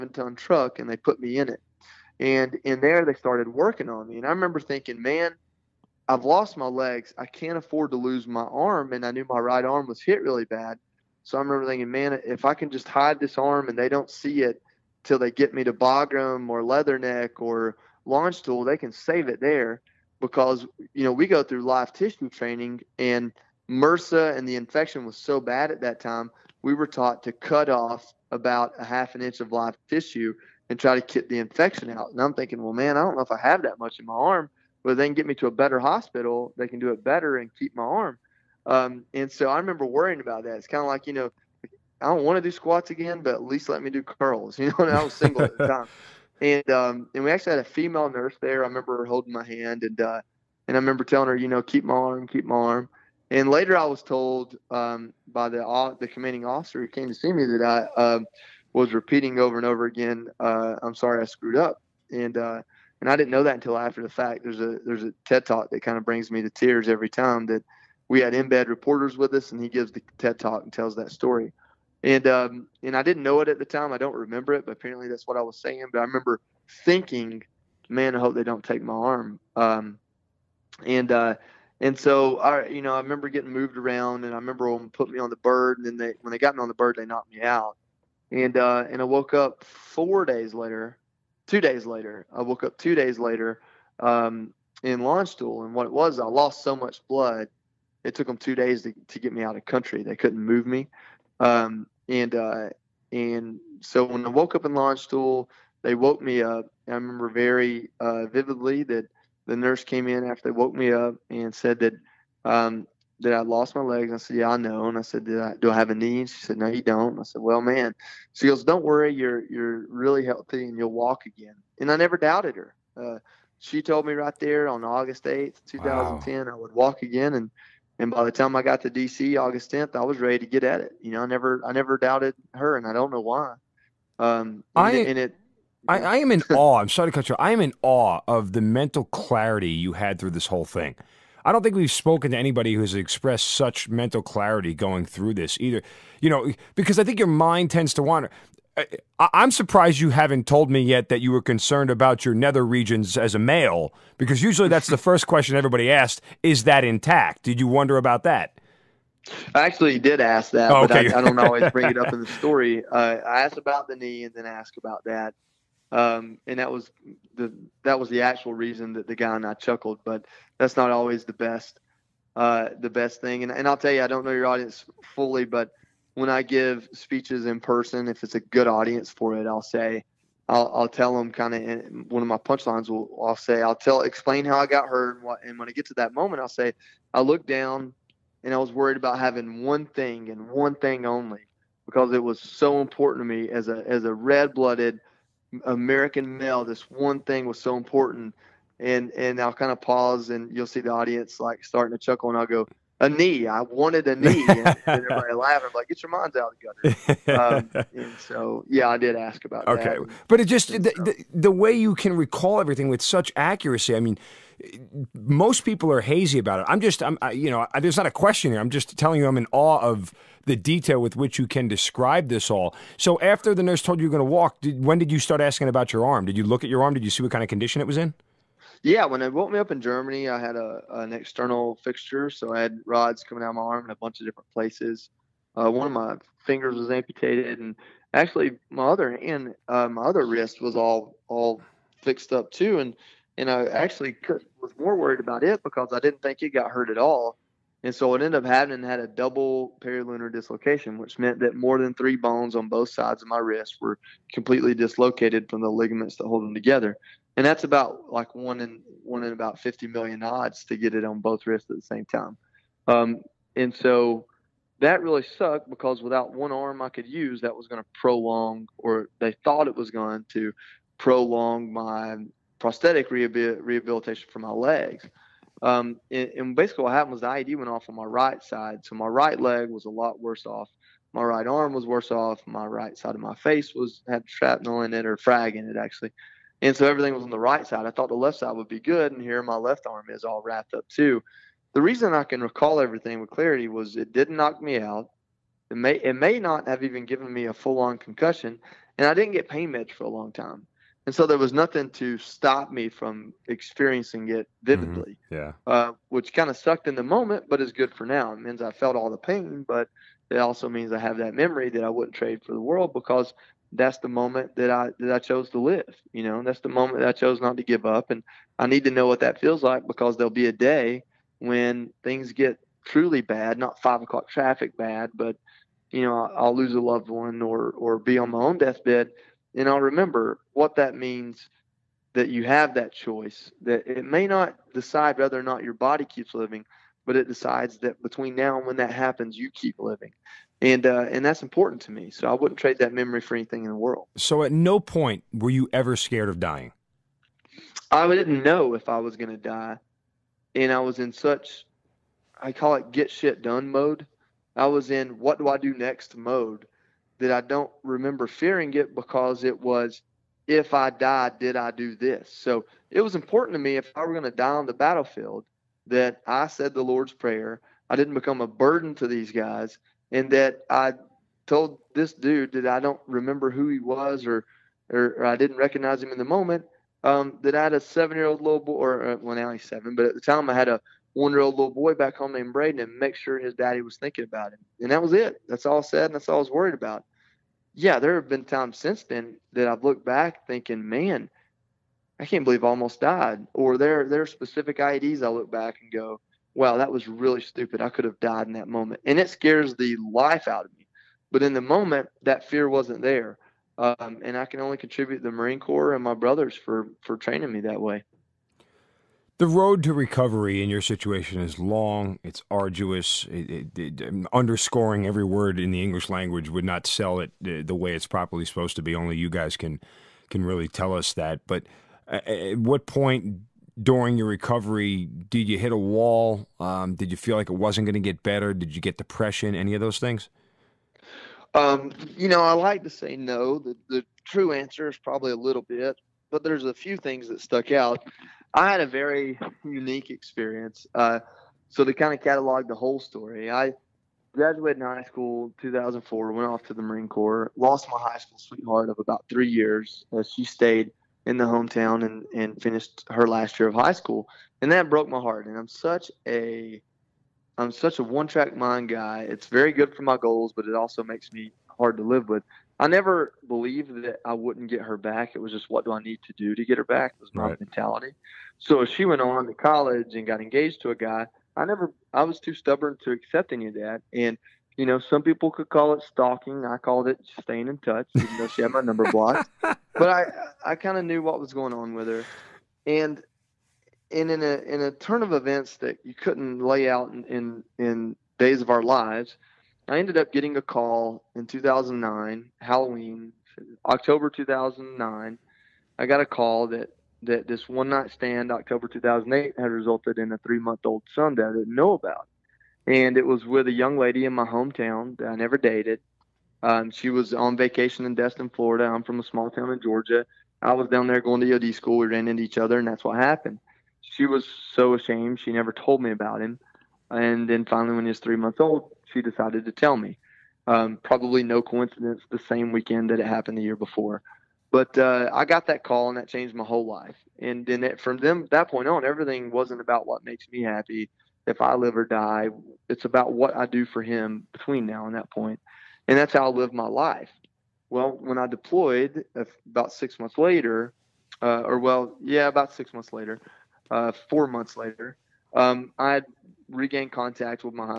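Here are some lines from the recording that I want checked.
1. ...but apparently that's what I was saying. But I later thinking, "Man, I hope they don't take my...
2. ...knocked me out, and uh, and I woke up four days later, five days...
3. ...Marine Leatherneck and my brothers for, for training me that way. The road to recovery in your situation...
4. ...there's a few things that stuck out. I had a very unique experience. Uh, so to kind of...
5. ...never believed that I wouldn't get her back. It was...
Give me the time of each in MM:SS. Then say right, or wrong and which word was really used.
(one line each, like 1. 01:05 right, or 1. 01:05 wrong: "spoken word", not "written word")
1. 01:14 wrong: "remember", not "later"
2. 01:27 wrong: "two", not "five"
3. 06:45 wrong: "Corps", not "Leatherneck"
4. 07:16 right
5. 07:42 right.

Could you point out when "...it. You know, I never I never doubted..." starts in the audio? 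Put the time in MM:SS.
02:10.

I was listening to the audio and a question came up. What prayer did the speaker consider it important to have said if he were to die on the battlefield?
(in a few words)
The Lord's Prayer.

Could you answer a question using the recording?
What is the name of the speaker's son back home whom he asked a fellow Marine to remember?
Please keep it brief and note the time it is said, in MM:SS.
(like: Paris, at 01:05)
Braden, at 06:22.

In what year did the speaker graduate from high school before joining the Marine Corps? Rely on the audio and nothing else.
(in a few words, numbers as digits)
2004.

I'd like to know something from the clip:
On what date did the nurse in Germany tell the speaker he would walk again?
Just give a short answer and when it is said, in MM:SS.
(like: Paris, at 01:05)
August 8, 2010, at 02:04.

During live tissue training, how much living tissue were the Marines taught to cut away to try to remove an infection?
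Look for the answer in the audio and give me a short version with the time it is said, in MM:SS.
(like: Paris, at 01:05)
half an inch, at 00:28.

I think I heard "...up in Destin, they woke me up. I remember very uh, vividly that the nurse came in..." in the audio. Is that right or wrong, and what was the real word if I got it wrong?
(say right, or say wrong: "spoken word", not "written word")
wrong: "Landstuhl", not "Destin".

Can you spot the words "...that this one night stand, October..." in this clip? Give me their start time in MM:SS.
08:17.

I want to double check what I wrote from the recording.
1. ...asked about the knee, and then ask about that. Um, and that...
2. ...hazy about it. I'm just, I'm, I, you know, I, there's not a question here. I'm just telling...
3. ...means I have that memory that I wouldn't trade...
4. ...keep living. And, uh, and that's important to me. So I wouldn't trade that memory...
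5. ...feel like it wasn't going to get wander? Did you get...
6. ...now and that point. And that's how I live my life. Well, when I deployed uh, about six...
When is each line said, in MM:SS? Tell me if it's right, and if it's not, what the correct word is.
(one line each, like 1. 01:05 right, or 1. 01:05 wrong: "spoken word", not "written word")
1. 02:43 right
2. 03:36 right
3. 05:10 right
4. 05:39 right
5. 07:07 wrong: "better", not "wander"
6. 08:54 right.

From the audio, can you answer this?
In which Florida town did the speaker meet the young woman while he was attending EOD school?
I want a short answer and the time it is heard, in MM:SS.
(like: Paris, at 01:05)
Destin, at 08:28.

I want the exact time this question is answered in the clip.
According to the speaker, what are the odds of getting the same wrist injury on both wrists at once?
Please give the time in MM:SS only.
04:19.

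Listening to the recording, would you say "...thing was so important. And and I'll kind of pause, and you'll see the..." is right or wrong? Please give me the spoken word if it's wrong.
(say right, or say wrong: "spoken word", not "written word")
right.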